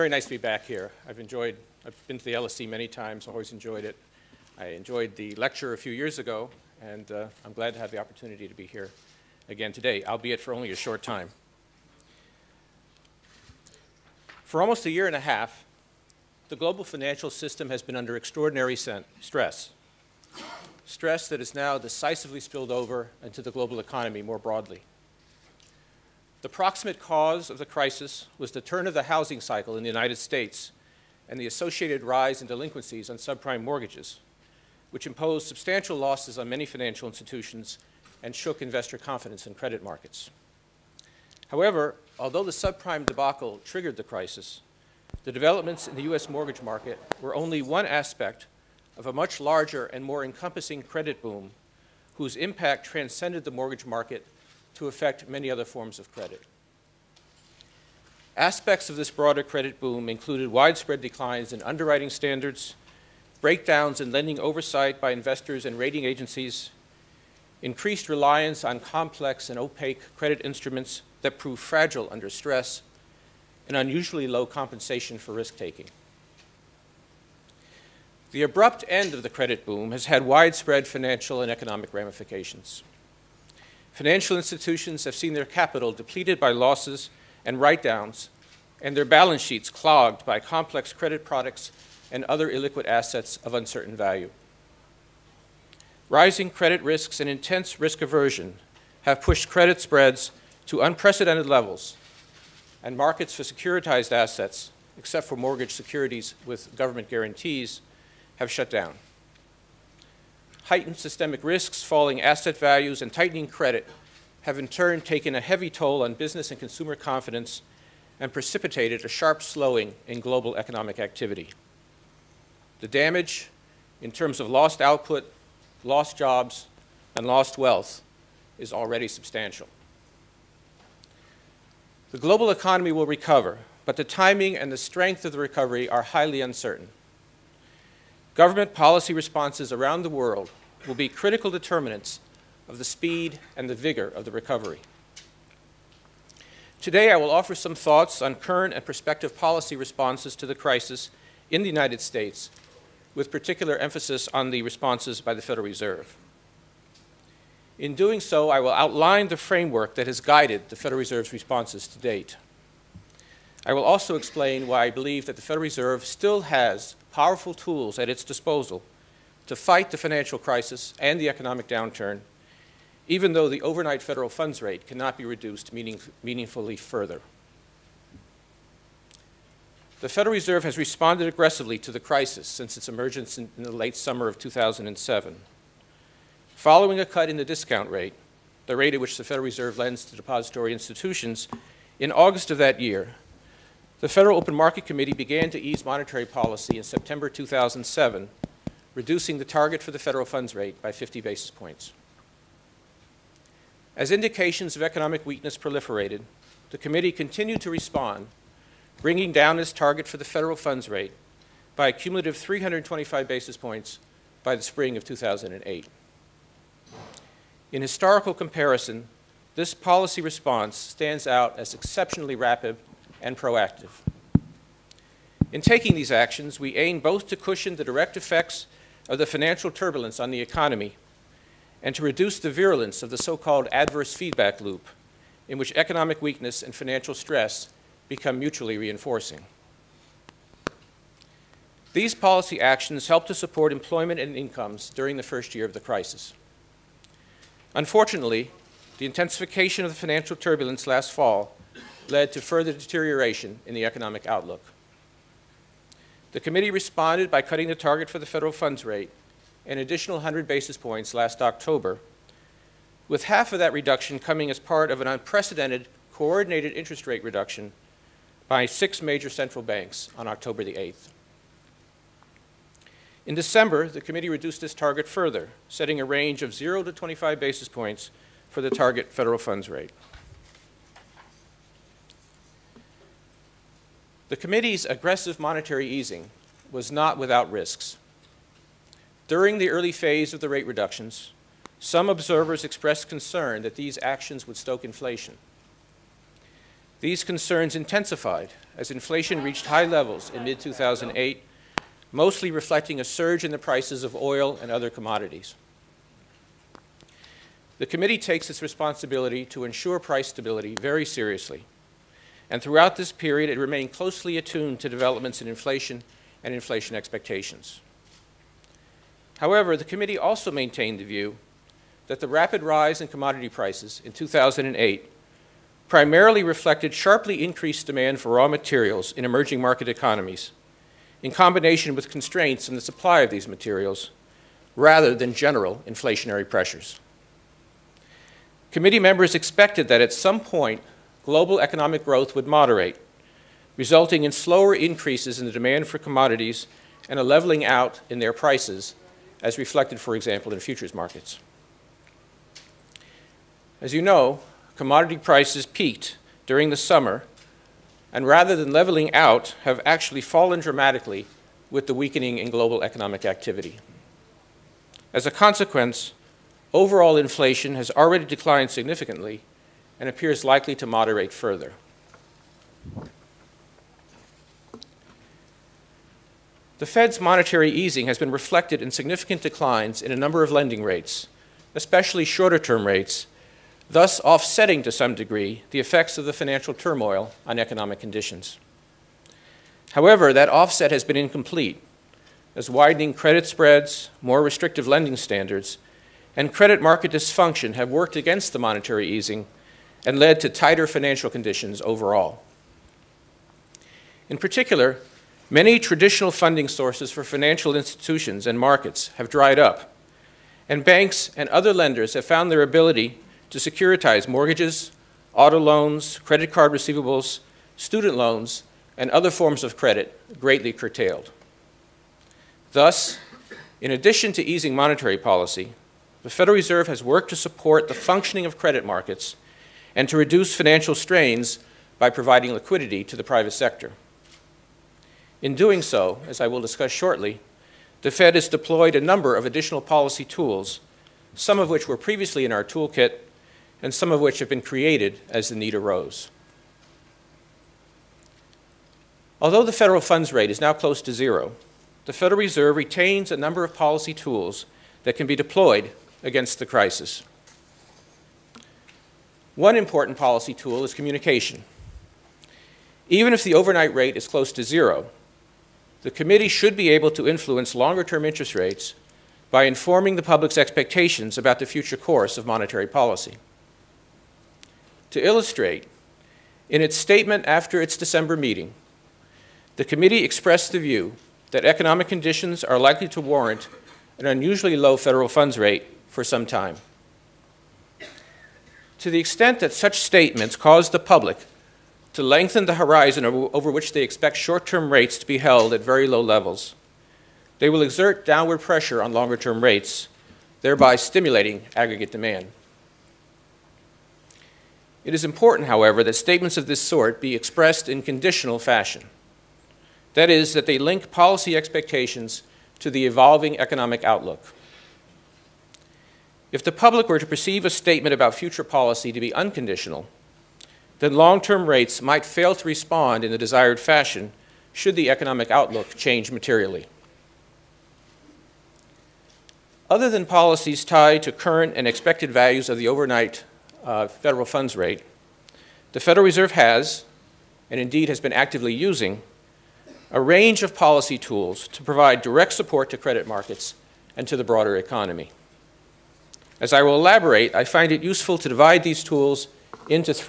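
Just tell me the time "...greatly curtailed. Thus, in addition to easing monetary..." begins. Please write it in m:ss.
7:00.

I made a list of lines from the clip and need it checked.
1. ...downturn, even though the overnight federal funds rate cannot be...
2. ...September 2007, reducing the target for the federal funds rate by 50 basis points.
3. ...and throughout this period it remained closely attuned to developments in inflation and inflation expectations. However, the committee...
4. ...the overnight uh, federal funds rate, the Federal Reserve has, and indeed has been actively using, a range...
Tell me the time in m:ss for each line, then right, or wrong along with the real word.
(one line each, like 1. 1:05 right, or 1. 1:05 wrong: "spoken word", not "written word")
1. 2:51 right
2. 3:16 right
3. 5:12 right
4. 8:52 right.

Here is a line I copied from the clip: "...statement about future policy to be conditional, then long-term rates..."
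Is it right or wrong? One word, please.
wrong.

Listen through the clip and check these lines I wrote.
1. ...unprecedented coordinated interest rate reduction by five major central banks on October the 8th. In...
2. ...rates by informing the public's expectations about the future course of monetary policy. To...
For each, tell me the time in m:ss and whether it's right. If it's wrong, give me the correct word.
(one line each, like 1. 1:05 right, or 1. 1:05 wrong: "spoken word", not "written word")
1. 4:25 wrong: "six", not "five"
2. 7:48 right.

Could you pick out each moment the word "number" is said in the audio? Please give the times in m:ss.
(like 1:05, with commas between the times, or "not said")
6:20, 7:19, 7:33.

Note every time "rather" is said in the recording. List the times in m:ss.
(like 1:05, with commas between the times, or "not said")
5:34, 5:58.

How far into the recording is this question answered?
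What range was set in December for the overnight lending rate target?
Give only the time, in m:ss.
4:36.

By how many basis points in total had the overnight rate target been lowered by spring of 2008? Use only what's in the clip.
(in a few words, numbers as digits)
325.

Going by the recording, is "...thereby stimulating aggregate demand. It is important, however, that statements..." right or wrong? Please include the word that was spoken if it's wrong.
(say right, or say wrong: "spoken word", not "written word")
right.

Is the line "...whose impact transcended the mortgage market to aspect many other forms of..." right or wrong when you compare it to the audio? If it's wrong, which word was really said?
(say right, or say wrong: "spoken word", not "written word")
wrong: "affect", not "aspect".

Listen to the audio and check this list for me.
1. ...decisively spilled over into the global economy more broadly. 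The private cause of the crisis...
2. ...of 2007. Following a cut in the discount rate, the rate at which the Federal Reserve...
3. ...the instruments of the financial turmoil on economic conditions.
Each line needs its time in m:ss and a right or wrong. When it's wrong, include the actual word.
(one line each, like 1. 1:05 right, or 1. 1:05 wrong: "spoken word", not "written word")
1. 0:21 wrong: "proximate", not "private"
2. 3:04 right
3. 6:25 wrong: "effects", not "instruments".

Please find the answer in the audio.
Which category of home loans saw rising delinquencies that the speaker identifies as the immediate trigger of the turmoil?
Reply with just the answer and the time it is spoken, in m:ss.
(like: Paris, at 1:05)
subprime mortgages, at 0:33.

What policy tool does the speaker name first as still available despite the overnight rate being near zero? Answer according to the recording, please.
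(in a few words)
communication.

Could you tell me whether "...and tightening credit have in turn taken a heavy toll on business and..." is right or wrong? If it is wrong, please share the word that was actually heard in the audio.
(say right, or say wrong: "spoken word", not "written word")
right.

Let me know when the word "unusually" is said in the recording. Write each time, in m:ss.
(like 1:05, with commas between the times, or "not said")
1:13, 8:04.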